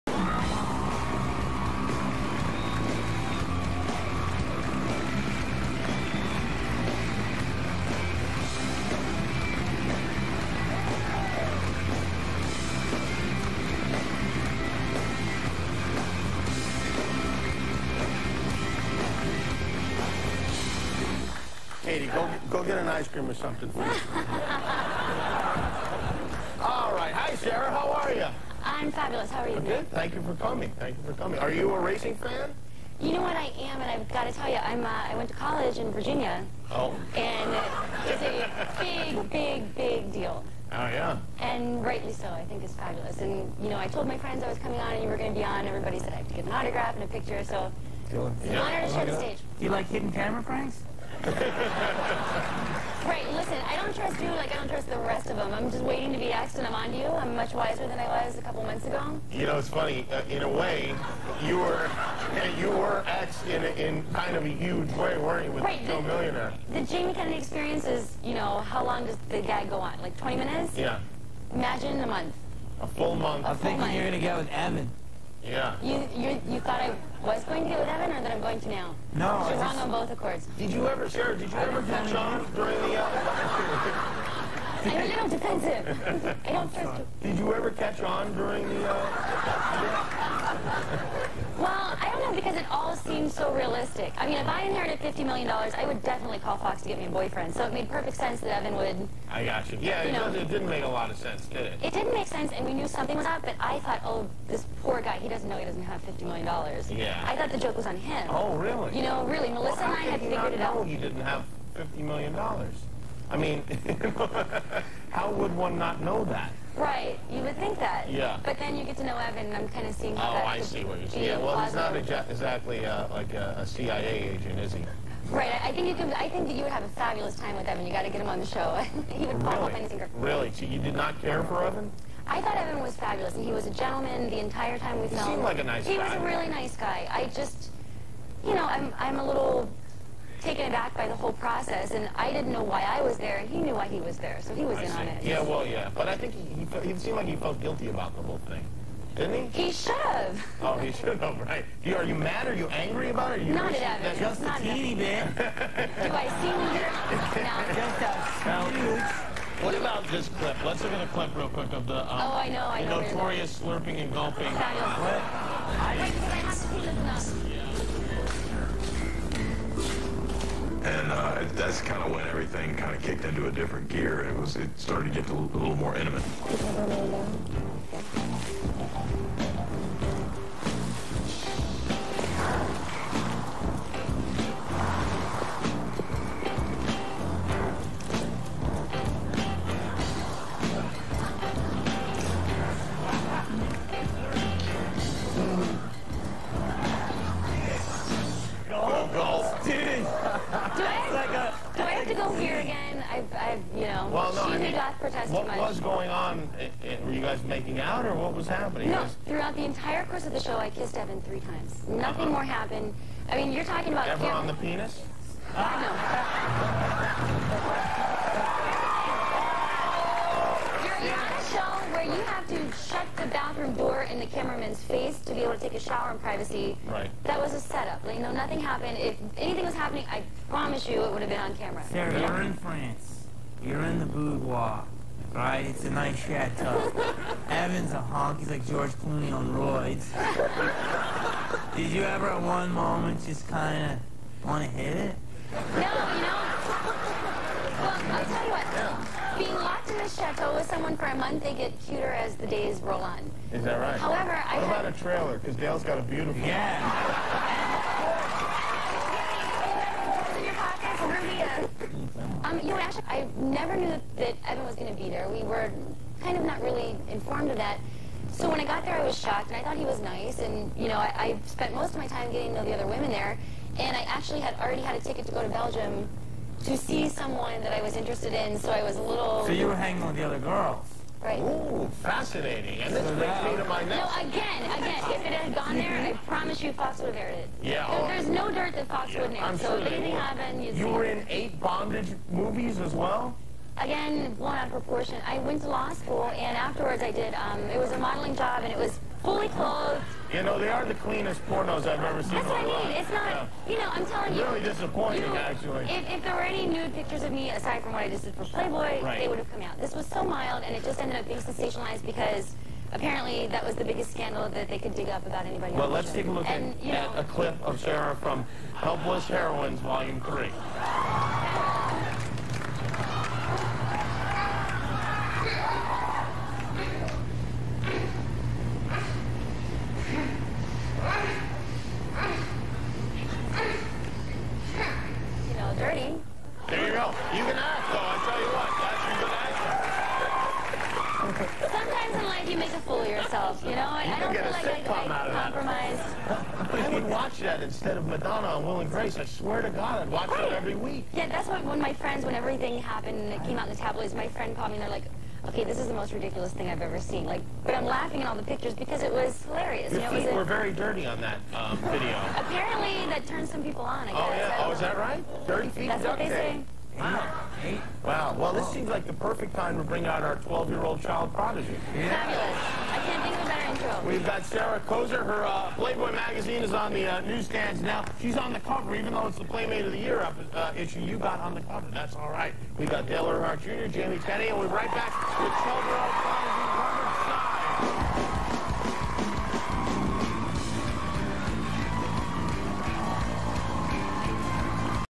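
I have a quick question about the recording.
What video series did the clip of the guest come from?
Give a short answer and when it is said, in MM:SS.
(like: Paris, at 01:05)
Helpless Heroines, at 05:18.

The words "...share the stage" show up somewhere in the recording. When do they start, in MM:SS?
00:48.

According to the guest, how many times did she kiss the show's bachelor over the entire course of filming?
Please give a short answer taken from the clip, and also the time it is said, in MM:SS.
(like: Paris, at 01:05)
3, at 03:31.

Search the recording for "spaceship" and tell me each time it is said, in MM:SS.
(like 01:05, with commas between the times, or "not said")
not said.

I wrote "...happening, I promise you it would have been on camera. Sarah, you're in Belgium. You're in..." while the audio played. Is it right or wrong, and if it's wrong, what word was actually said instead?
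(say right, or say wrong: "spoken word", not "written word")
wrong: "France", not "Belgium".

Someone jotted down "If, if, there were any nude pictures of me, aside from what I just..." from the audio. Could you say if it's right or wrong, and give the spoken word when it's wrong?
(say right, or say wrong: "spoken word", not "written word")
right.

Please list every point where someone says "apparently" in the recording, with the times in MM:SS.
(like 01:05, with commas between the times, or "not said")
05:12, 06:02.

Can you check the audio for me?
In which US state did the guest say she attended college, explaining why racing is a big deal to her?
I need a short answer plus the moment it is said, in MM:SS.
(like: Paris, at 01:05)
Virginia, at 00:35.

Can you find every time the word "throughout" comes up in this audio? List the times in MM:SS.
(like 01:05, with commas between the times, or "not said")
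03:29.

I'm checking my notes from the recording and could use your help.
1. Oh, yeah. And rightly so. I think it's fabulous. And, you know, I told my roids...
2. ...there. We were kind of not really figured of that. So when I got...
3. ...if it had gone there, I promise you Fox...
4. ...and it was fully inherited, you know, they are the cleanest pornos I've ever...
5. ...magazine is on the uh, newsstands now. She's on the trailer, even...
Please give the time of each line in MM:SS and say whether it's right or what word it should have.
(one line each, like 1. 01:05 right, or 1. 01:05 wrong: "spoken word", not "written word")
1. 00:40 wrong: "friends", not "roids"
2. 04:25 wrong: "informed", not "figured"
3. 04:45 right
4. 04:58 wrong: "clothed", not "inherited"
5. 06:16 wrong: "cover", not "trailer".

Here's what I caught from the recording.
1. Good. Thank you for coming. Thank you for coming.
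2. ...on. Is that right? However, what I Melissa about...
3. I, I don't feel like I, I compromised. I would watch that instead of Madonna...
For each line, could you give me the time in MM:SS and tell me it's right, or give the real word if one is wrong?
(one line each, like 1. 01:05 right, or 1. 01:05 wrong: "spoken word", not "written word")
1. 00:29 right
2. 04:13 wrong: "What", not "Melissa"
3. 05:43 right.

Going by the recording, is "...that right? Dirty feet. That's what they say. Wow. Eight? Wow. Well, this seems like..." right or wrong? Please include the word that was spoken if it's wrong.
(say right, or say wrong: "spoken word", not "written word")
right.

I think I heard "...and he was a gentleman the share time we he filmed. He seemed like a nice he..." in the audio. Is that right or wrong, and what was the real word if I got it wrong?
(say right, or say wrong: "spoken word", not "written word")
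wrong: "entire", not "share".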